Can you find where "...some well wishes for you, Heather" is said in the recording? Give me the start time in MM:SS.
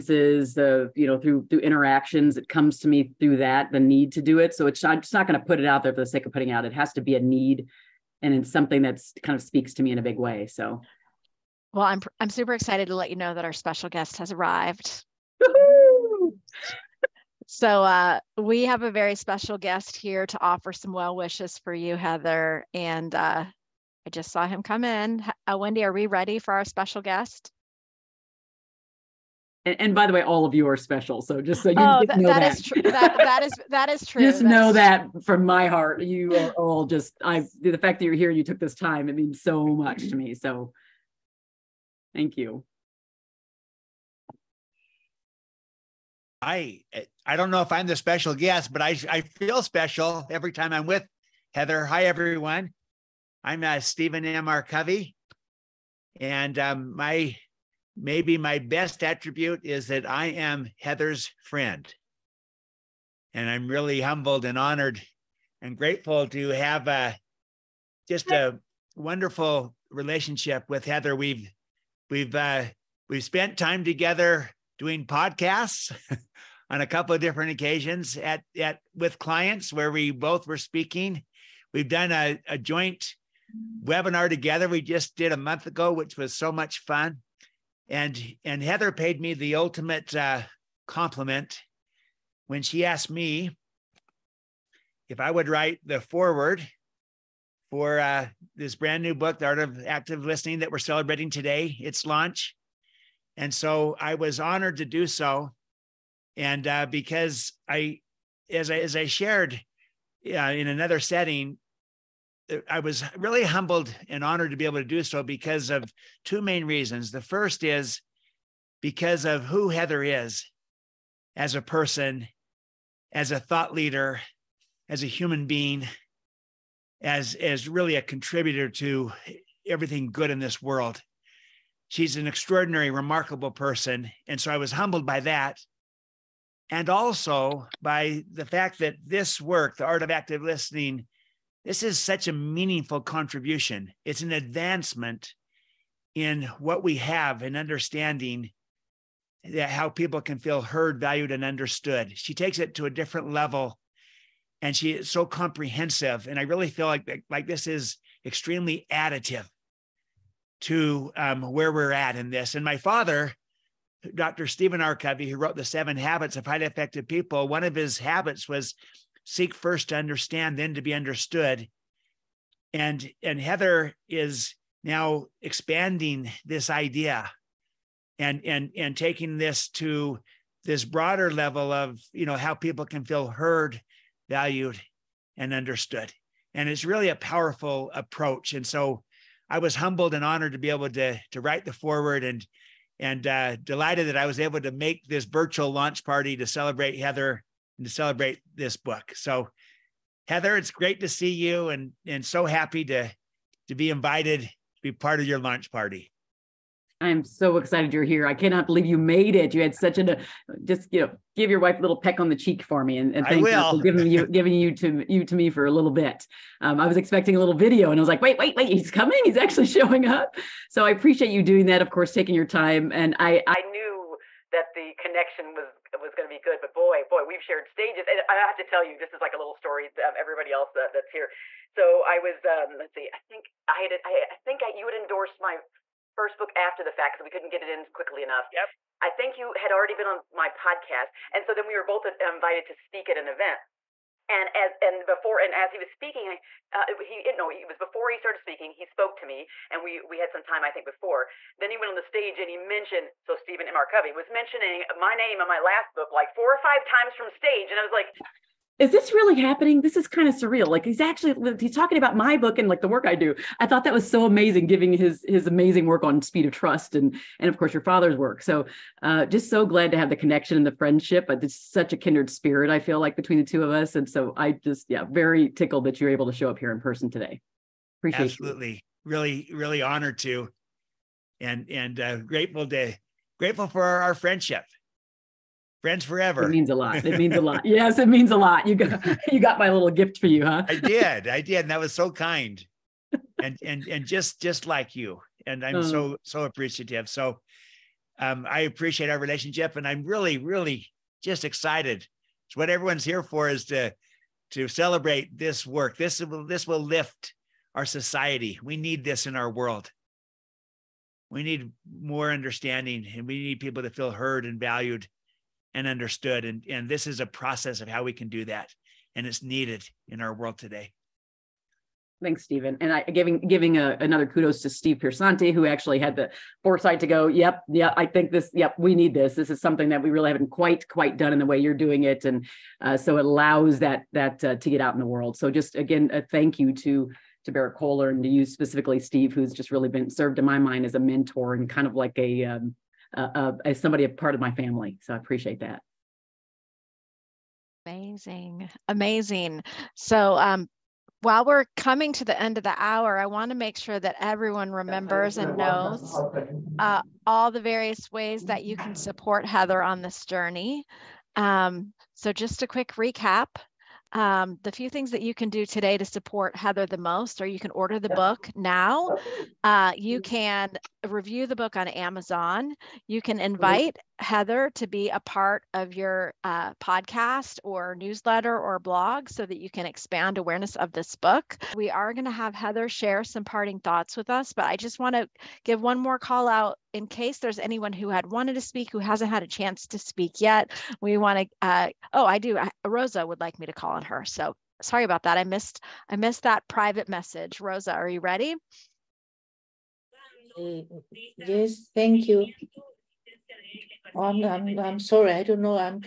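00:20.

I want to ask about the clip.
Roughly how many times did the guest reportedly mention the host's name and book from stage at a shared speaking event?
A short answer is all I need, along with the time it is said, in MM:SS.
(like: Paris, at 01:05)
4 or 5, at 04:16.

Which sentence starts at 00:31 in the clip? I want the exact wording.
So just so you oh, know that, that.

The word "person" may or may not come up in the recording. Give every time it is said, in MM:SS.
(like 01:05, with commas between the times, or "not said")
02:01, 02:13, 04:36.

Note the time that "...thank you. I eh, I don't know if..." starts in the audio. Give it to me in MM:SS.
00:42.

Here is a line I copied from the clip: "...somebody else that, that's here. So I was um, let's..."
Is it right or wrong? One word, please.
wrong.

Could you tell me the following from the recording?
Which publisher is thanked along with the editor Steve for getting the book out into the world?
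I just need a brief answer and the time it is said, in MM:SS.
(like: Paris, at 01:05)
Berrett-Koehler, at 05:37.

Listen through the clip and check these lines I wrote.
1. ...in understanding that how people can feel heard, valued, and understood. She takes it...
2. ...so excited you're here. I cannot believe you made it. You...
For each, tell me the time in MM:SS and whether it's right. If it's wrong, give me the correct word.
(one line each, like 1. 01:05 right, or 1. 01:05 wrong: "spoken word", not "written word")
1. 02:27 right
2. 03:27 right.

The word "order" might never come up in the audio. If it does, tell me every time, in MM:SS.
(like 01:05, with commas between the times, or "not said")
06:07.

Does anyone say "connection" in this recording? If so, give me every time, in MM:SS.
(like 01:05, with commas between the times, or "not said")
03:44, 04:30.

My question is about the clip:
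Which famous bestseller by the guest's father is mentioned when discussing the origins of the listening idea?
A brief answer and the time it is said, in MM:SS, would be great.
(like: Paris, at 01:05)
The Seven Habits of Highly Effective People, at 02:45.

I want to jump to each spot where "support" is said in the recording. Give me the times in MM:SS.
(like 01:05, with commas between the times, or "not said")
05:58, 06:06.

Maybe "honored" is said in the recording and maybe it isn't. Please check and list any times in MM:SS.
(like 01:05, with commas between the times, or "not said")
01:04, 01:44, 01:54, 03:10, 04:39.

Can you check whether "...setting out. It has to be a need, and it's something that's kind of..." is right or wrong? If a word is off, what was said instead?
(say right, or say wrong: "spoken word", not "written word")
wrong: "putting", not "setting".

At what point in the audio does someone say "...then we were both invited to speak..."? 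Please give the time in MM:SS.
04:01.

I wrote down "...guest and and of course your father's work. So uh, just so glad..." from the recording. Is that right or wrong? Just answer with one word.
wrong.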